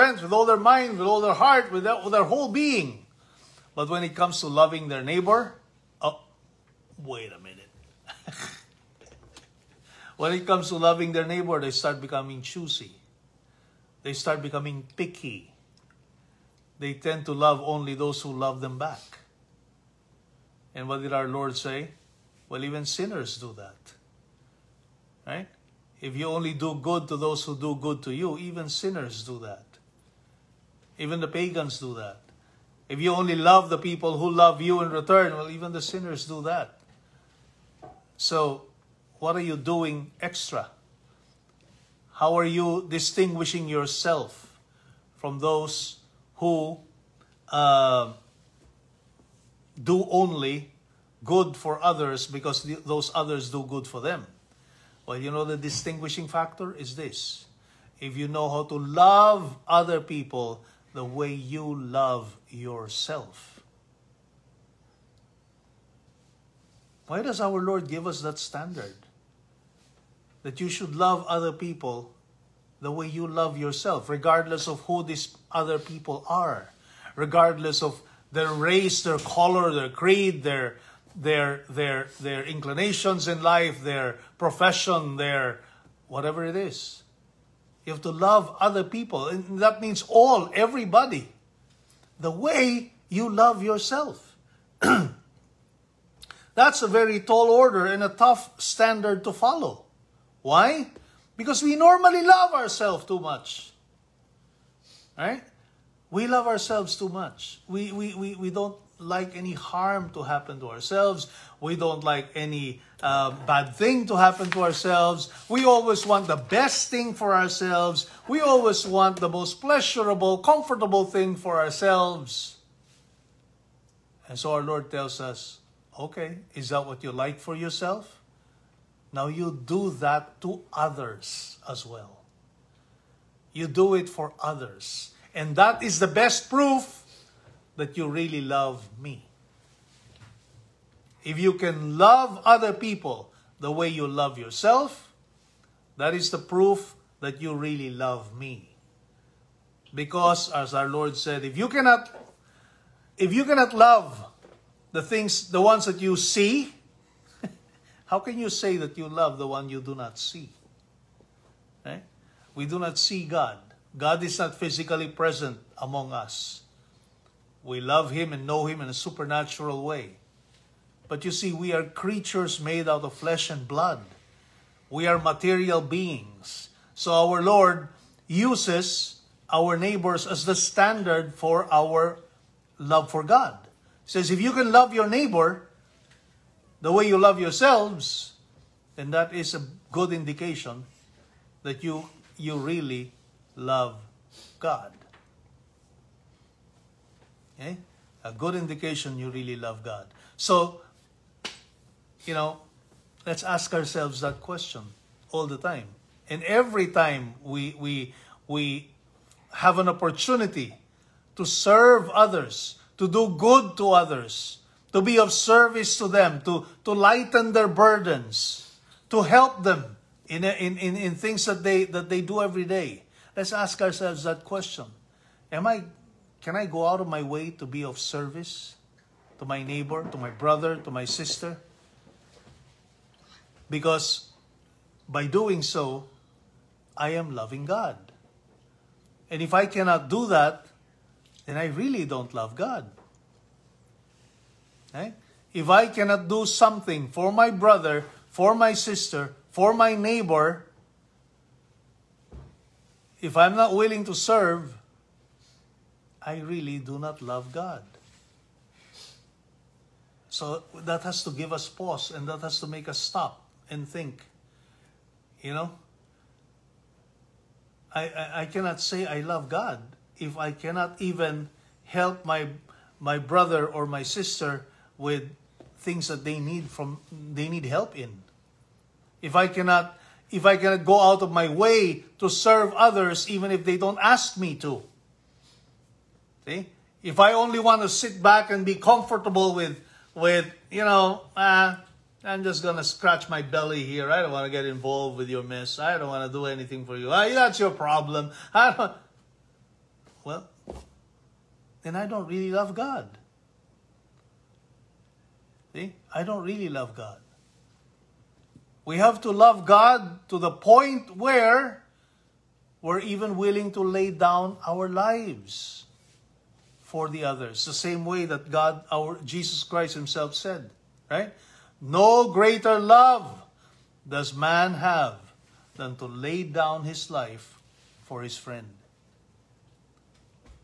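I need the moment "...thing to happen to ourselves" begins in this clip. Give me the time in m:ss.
1:53.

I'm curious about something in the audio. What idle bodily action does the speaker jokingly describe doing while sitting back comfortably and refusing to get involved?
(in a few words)
scratch my belly.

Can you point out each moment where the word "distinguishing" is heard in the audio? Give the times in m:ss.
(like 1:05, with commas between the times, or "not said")
0:42, 0:55.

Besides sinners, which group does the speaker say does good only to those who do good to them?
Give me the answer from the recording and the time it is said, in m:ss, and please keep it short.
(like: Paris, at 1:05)
pagans, at 0:31.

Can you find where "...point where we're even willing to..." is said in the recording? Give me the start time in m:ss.
5:10.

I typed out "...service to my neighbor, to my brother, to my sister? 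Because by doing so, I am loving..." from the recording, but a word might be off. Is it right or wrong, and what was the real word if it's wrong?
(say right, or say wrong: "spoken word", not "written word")
right.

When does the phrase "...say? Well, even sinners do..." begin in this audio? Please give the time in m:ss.
0:21.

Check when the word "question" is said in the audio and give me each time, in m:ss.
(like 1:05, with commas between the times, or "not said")
3:24, 3:44.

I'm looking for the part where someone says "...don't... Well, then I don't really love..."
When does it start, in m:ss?
4:58.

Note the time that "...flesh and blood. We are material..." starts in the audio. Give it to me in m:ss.
2:53.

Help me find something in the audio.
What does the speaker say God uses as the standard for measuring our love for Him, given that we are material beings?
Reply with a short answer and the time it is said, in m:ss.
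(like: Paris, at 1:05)
our neighbors, at 2:59.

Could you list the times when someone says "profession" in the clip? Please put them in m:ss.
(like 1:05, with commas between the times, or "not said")
1:24.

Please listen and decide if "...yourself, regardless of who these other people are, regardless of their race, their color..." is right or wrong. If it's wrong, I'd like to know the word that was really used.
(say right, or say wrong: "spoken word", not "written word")
right.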